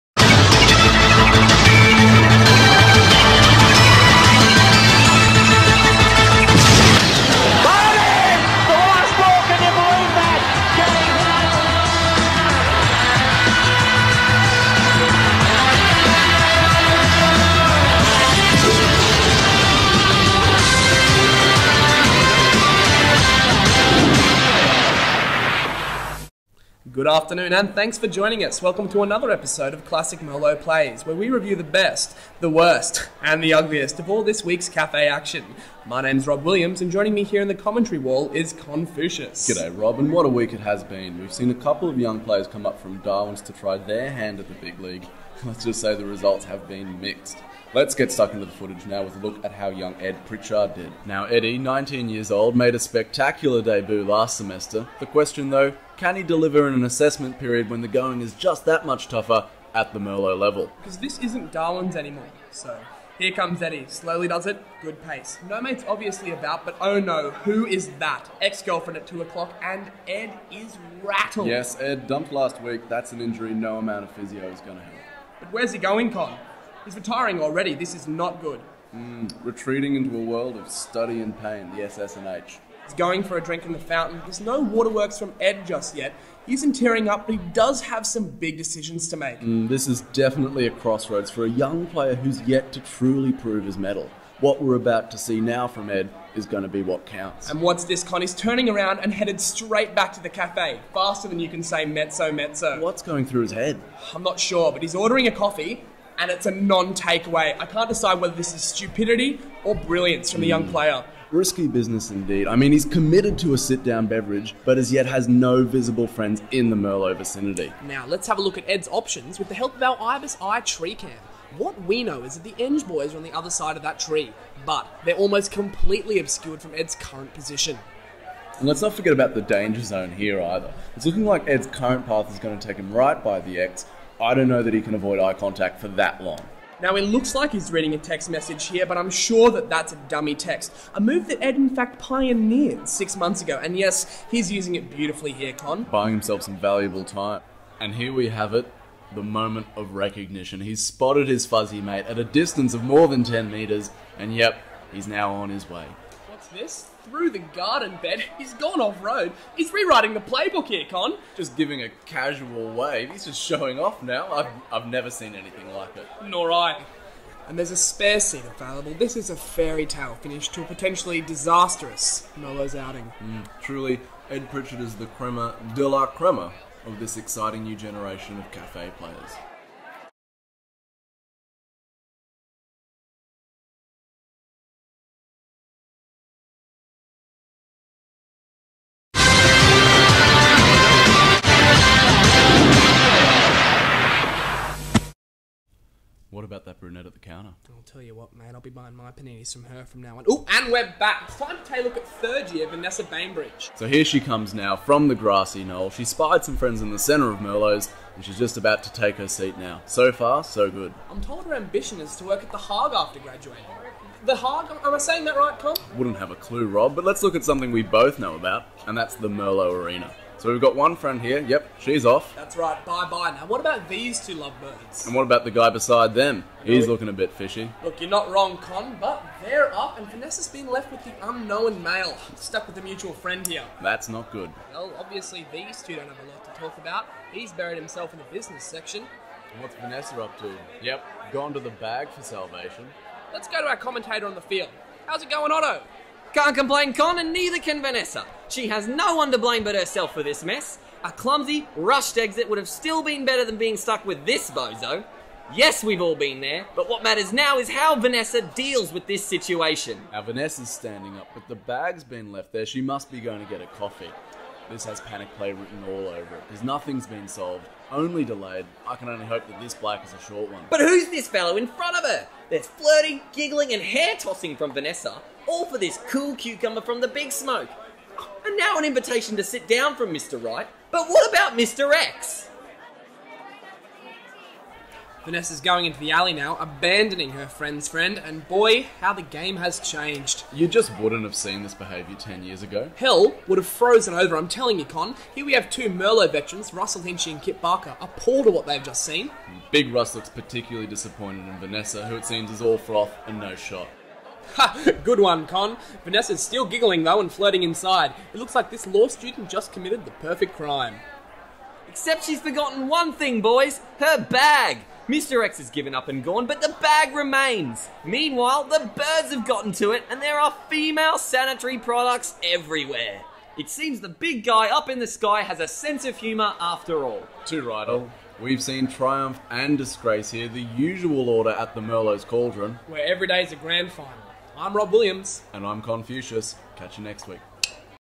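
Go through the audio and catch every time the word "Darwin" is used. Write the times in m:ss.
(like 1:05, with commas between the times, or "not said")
0:42, 1:01.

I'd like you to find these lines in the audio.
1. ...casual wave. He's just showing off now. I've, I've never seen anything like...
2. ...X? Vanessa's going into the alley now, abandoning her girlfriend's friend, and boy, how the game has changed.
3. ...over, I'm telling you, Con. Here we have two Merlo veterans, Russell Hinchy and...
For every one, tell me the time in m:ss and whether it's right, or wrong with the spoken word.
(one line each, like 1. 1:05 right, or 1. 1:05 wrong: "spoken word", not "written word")
1. 2:42 right
2. 4:41 wrong: "friend", not "girlfriend"
3. 4:54 right.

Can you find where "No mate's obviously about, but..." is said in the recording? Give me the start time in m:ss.
1:05.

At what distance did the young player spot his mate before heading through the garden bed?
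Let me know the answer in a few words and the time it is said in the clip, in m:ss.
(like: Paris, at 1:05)
more than 10 meters, at 2:32.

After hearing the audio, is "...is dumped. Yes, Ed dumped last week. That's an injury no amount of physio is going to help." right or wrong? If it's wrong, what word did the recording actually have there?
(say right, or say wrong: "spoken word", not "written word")
wrong: "rattled", not "dumped".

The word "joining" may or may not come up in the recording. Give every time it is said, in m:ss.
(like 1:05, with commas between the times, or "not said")
0:28, 0:36.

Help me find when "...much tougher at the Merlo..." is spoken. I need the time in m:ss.
0:58.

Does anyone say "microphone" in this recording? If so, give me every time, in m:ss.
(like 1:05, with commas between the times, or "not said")
not said.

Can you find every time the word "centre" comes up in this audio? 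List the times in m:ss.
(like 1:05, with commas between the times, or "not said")
3:26.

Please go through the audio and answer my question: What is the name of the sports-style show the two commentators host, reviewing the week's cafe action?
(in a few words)
Classic Merlo Plays.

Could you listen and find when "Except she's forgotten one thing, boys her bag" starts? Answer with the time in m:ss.
5:11.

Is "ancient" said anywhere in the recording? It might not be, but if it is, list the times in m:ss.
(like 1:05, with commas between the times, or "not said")
not said.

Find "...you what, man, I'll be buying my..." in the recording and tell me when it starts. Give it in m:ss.
3:18.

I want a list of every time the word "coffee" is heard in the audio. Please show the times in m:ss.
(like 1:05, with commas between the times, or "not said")
1:45, 4:23.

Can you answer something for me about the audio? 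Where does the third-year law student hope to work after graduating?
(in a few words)
the Hague.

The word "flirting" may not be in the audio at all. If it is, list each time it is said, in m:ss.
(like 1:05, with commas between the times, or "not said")
4:32, 5:07.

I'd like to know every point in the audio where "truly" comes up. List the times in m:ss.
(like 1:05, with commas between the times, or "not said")
1:32, 2:53.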